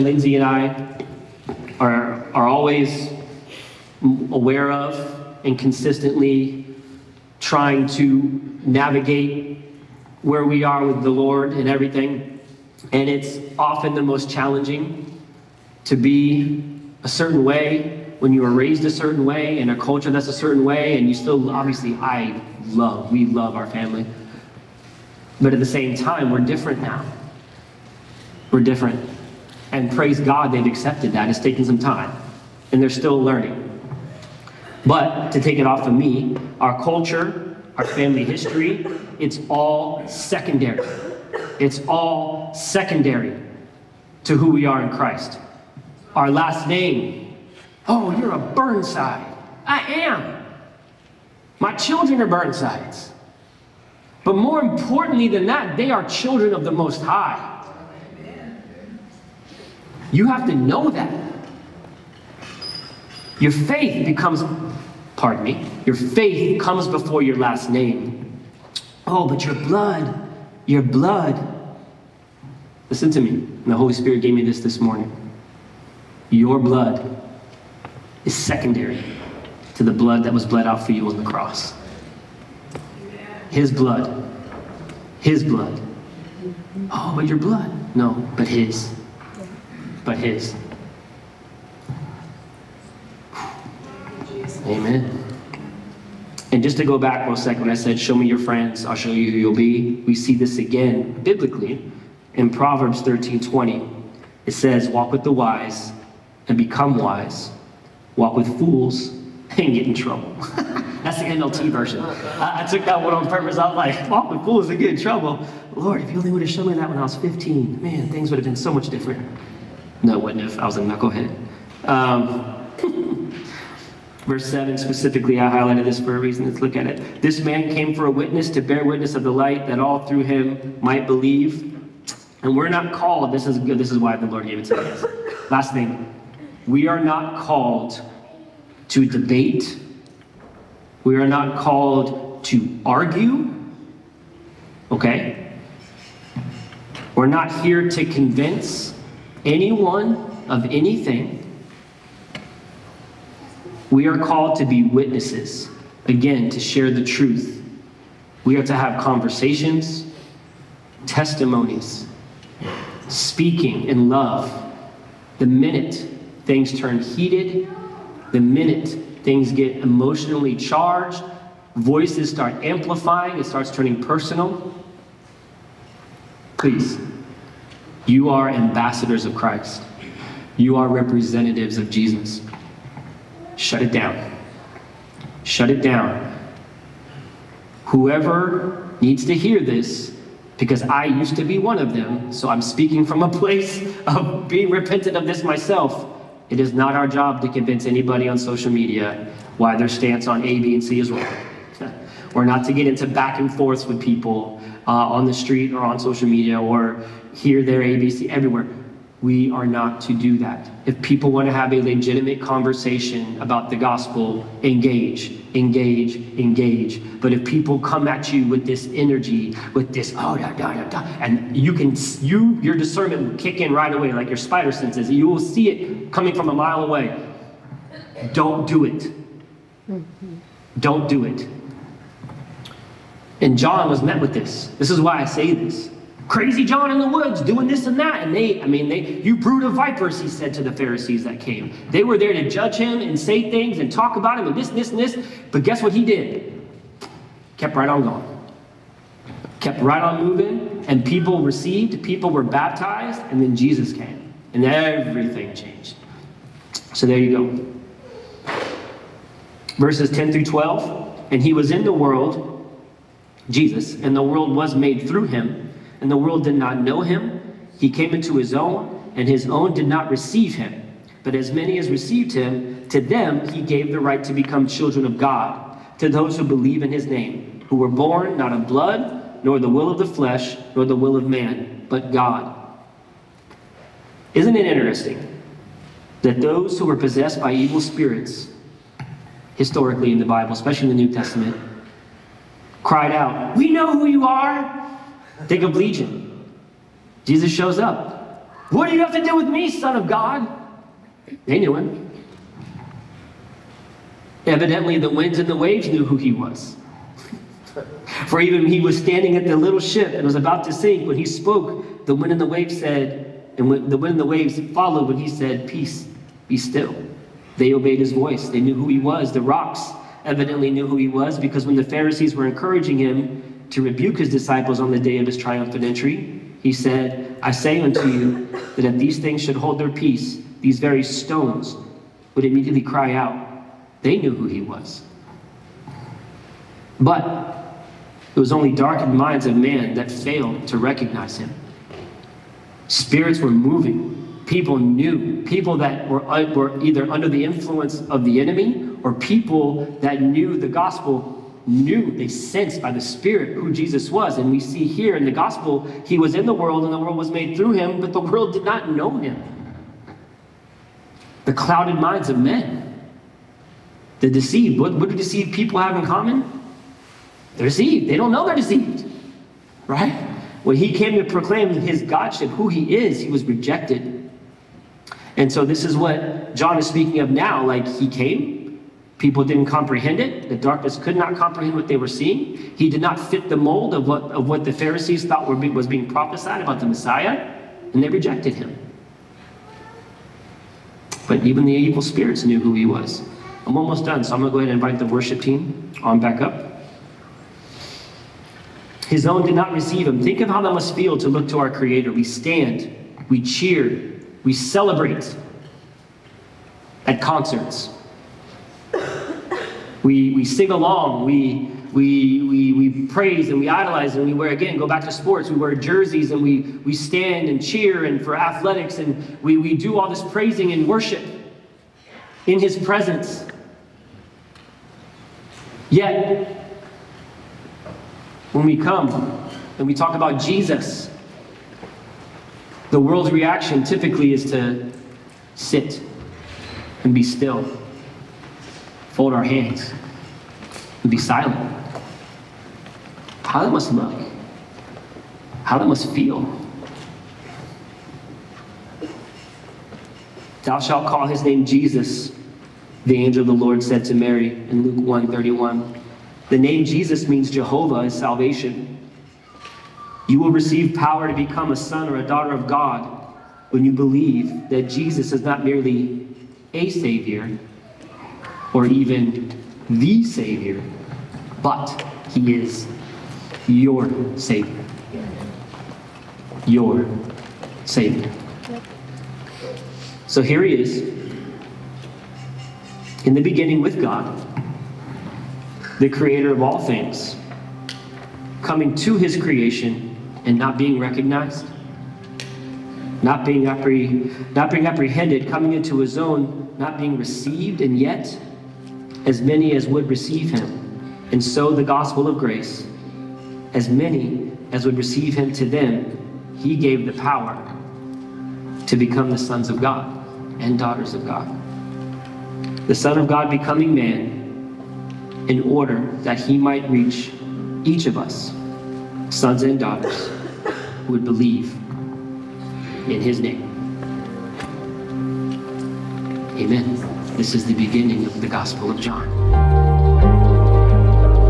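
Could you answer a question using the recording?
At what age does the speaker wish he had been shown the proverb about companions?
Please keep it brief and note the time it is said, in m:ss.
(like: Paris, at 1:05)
15, at 1:57.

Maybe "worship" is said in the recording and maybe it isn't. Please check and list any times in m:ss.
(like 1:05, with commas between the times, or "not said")
6:35, 7:00.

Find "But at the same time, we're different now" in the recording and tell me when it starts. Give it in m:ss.
0:25.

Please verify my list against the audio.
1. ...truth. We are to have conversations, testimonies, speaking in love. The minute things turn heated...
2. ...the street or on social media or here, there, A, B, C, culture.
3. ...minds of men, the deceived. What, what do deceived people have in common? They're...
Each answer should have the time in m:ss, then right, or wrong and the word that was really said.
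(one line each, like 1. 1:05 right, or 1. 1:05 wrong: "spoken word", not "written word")
1. 2:37 right
2. 3:25 wrong: "everywhere", not "culture"
3. 6:01 right.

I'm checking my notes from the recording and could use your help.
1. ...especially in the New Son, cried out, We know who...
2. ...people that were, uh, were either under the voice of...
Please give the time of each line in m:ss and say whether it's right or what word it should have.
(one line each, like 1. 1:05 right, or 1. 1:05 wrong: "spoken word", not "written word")
1. 4:50 wrong: "Testament", not "Son"
2. 5:45 wrong: "influence", not "voice".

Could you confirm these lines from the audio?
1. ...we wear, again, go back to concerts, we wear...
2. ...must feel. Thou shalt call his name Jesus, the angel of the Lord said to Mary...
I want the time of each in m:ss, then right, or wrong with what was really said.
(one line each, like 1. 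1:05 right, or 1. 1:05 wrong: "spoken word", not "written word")
1. 6:54 wrong: "sports", not "concerts"
2. 7:25 right.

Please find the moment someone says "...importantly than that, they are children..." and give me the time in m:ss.
0:54.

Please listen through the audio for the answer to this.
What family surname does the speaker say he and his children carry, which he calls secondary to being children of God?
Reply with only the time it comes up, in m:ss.
0:48.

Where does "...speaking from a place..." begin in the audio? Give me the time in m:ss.
3:12.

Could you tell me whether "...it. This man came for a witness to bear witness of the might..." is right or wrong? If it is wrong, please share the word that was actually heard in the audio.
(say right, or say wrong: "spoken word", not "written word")
wrong: "light", not "might".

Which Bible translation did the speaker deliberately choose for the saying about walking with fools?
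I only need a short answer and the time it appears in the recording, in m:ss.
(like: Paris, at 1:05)
NLT, at 1:51.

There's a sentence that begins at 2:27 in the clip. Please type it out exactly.
We're not here to convince anyone of anything.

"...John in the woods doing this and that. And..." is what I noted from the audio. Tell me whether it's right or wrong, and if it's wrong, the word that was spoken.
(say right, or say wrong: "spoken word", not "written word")
right.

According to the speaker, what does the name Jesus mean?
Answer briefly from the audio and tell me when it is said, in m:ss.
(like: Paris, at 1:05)
Jehovah is salvation, at 7:37.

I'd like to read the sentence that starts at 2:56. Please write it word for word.
Please, you are ambassadors of Christ, you are representatives of Jesus.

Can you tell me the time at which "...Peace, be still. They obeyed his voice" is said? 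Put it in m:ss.
5:15.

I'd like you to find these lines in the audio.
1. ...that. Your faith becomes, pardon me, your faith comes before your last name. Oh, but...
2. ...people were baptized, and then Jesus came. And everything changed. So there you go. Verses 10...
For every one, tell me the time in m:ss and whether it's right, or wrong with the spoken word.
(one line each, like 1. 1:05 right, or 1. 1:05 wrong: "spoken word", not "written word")
1. 1:00 right
2. 4:12 right.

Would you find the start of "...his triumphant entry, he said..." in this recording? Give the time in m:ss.
5:25.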